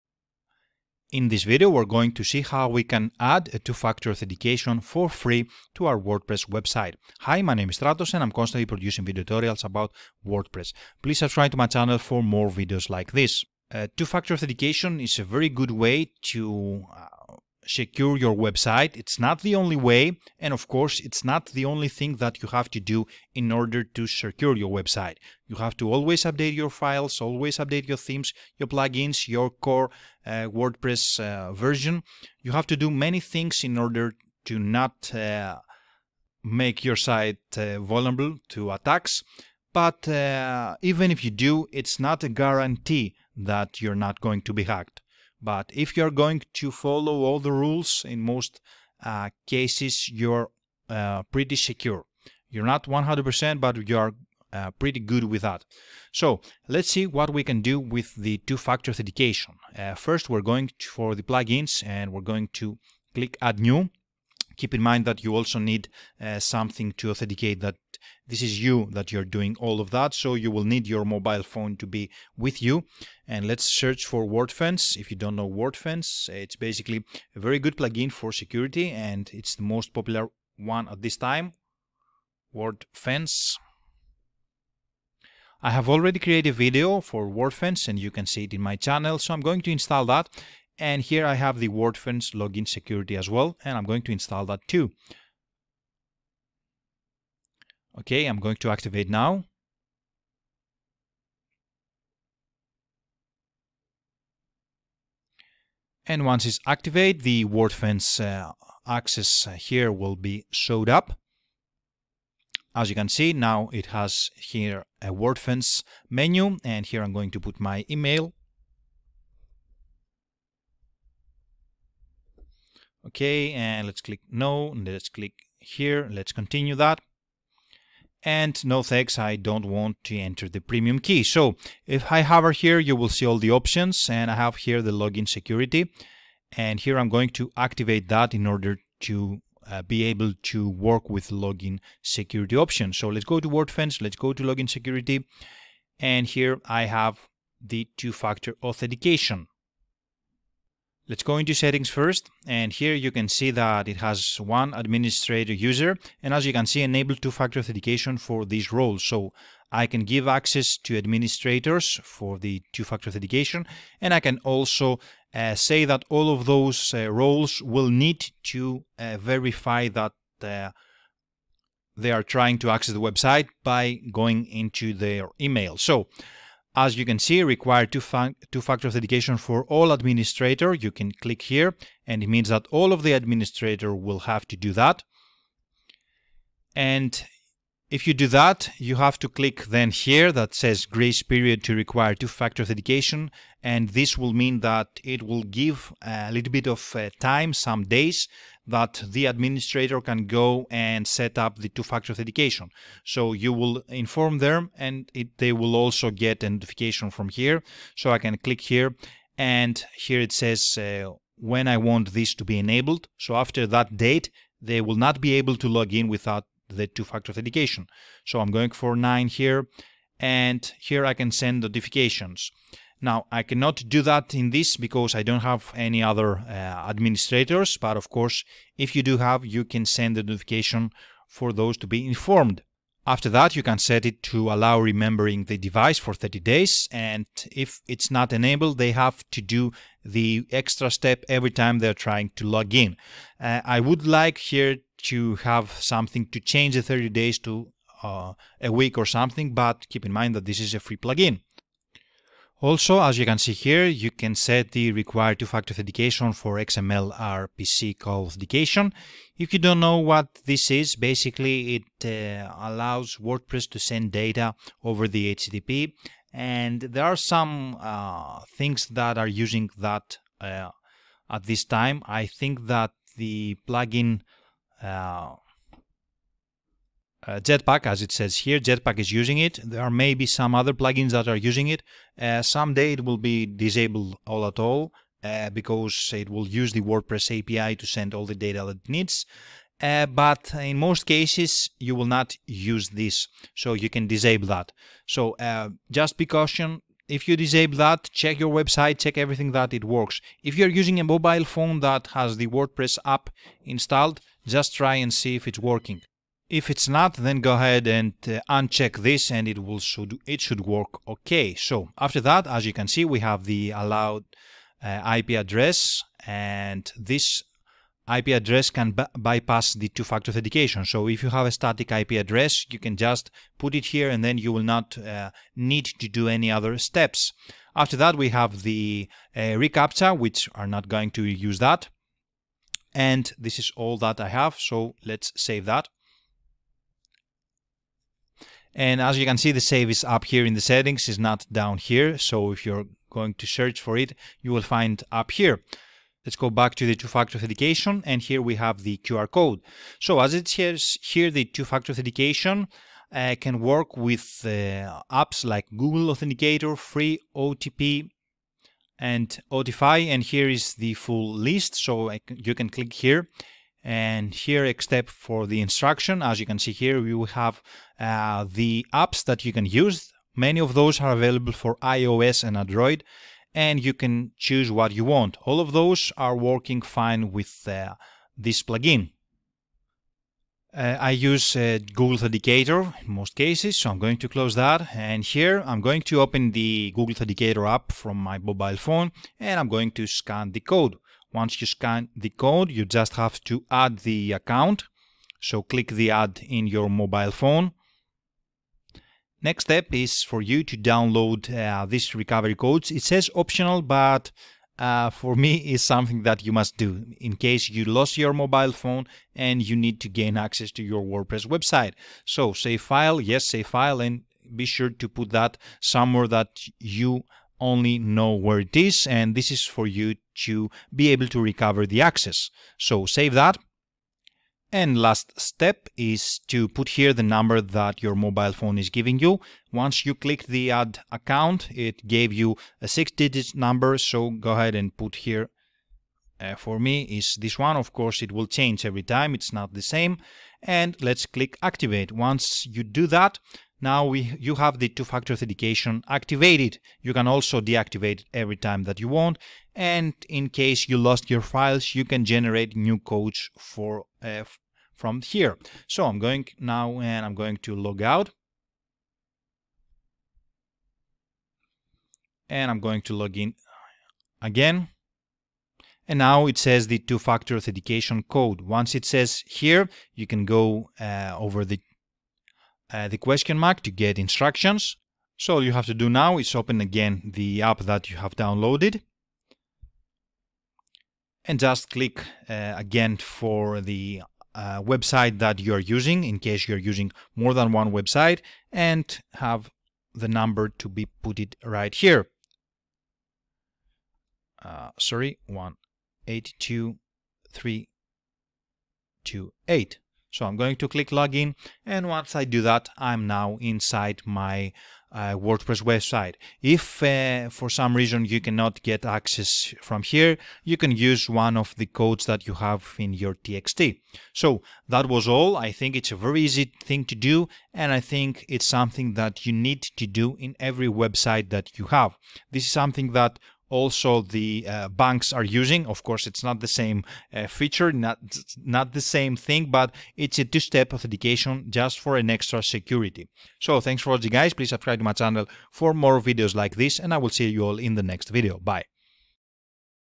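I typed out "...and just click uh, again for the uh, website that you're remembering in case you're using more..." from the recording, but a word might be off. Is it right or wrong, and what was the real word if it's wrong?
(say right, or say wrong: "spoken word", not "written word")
wrong: "using", not "remembering".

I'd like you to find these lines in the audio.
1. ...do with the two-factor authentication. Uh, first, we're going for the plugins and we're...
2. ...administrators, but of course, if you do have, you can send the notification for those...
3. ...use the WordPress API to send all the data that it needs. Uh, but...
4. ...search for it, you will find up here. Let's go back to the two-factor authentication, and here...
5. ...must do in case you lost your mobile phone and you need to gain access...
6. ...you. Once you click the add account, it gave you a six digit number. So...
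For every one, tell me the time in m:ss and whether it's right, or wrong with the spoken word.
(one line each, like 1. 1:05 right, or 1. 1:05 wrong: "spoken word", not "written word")
1. 0:57 right
2. 3:46 right
3. 4:46 right
4. 5:43 right
5. 6:46 right
6. 7:09 right.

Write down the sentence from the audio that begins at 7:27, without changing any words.
You can also deactivate it every time that you want.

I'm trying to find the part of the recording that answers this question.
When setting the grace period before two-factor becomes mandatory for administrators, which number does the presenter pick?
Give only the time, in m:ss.
3:38.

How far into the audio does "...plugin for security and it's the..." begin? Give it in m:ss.
1:17.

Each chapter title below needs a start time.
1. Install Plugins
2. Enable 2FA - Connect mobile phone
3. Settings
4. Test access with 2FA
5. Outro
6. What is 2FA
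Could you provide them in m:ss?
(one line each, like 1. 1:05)
1. 1:00
2. 5:46
3. 2:25
4. 7:42
5. 8:34
6. 0:14.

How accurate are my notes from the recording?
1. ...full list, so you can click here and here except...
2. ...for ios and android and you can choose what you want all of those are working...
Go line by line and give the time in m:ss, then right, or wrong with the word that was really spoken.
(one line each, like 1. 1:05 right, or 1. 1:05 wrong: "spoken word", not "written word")
1. 6:00 right
2. 6:11 right.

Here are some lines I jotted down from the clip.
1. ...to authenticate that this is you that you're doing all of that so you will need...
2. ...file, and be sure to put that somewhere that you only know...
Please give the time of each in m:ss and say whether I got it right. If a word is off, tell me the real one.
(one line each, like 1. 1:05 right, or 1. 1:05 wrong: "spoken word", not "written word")
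1. 1:06 right
2. 6:53 right.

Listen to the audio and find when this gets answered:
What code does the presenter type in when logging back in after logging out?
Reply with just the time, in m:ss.
8:15.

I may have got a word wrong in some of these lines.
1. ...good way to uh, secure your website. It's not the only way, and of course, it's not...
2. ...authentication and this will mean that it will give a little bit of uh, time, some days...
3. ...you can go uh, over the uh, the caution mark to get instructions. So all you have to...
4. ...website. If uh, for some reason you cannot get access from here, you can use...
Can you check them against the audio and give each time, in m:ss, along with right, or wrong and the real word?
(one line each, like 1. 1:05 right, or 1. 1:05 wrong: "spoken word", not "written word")
1. 0:15 right
2. 3:12 right
3. 7:50 wrong: "question", not "caution"
4. 8:25 right.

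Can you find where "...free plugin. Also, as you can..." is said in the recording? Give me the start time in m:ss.
4:10.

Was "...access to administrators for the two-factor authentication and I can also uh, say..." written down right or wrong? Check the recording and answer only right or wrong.
right.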